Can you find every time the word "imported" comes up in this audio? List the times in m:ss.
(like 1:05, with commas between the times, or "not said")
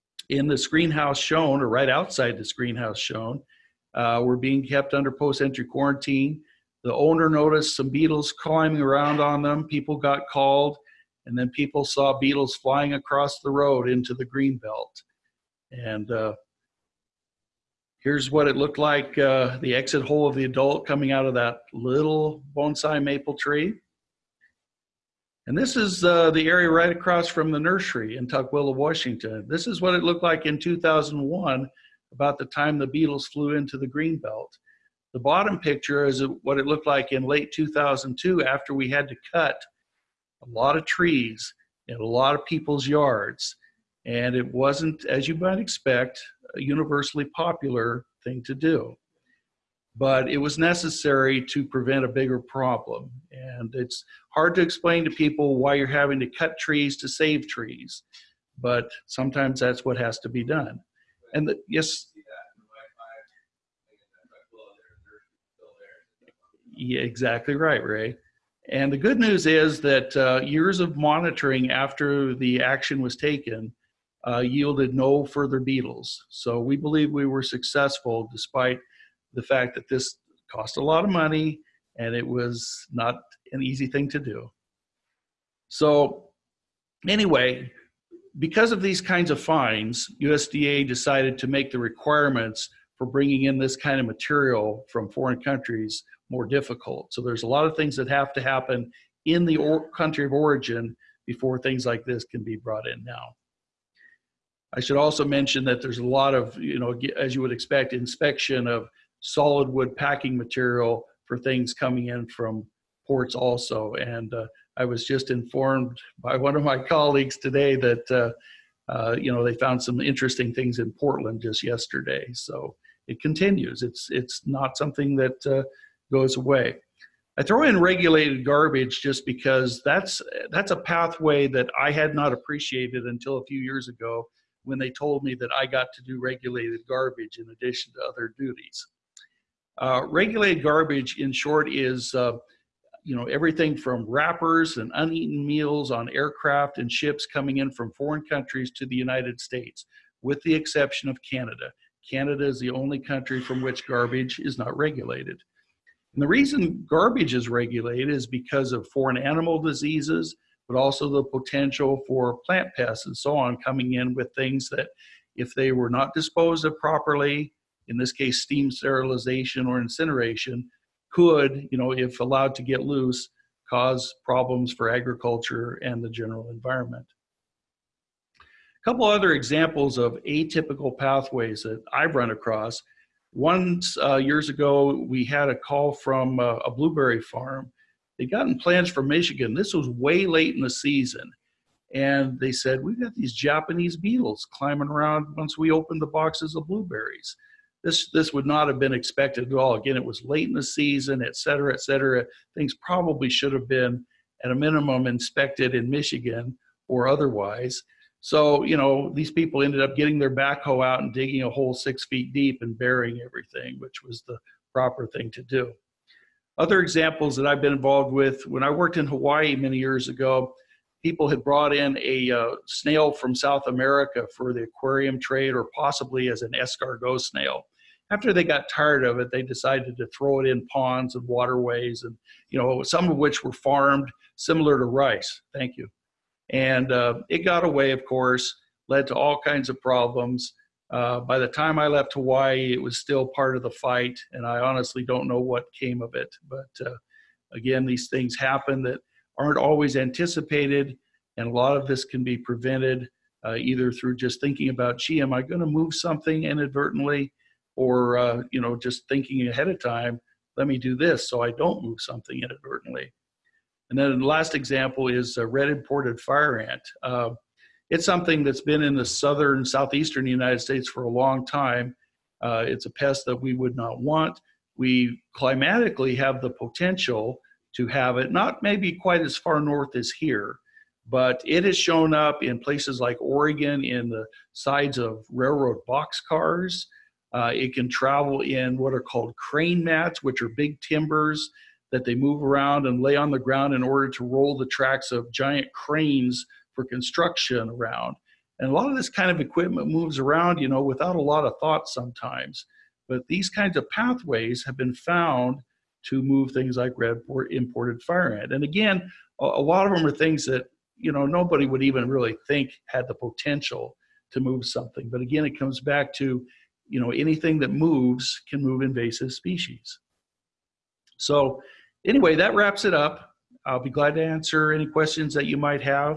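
4:25, 5:07.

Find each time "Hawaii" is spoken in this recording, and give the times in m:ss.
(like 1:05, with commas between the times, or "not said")
3:39, 4:02.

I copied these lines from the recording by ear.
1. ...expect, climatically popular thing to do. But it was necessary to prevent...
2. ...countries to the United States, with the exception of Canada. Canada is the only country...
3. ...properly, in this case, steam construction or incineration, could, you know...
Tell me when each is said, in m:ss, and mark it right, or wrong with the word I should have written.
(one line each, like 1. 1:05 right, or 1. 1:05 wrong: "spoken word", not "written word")
1. 0:45 wrong: "universally", not "climatically"
2. 2:28 right
3. 2:46 wrong: "sterilization", not "construction".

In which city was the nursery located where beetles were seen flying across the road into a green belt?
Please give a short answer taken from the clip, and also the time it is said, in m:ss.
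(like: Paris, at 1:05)
Tukwila, Washington, at 0:28.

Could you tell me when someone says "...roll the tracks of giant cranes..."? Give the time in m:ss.
4:54.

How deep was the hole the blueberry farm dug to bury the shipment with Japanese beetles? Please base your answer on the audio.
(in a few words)
6 feet.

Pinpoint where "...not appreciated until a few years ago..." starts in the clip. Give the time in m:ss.
2:12.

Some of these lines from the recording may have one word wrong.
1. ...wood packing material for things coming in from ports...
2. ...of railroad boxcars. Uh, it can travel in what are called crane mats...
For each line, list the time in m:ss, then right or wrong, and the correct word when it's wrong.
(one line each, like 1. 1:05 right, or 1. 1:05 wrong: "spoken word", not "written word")
1. 1:49 right
2. 4:44 right.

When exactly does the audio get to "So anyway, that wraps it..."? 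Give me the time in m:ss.
5:21.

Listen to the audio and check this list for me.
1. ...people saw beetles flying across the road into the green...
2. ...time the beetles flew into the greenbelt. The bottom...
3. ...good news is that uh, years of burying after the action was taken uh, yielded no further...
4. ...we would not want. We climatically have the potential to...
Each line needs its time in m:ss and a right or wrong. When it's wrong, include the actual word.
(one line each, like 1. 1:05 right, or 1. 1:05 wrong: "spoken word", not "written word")
1. 0:11 right
2. 0:32 right
3. 1:08 wrong: "monitoring", not "burying"
4. 4:33 right.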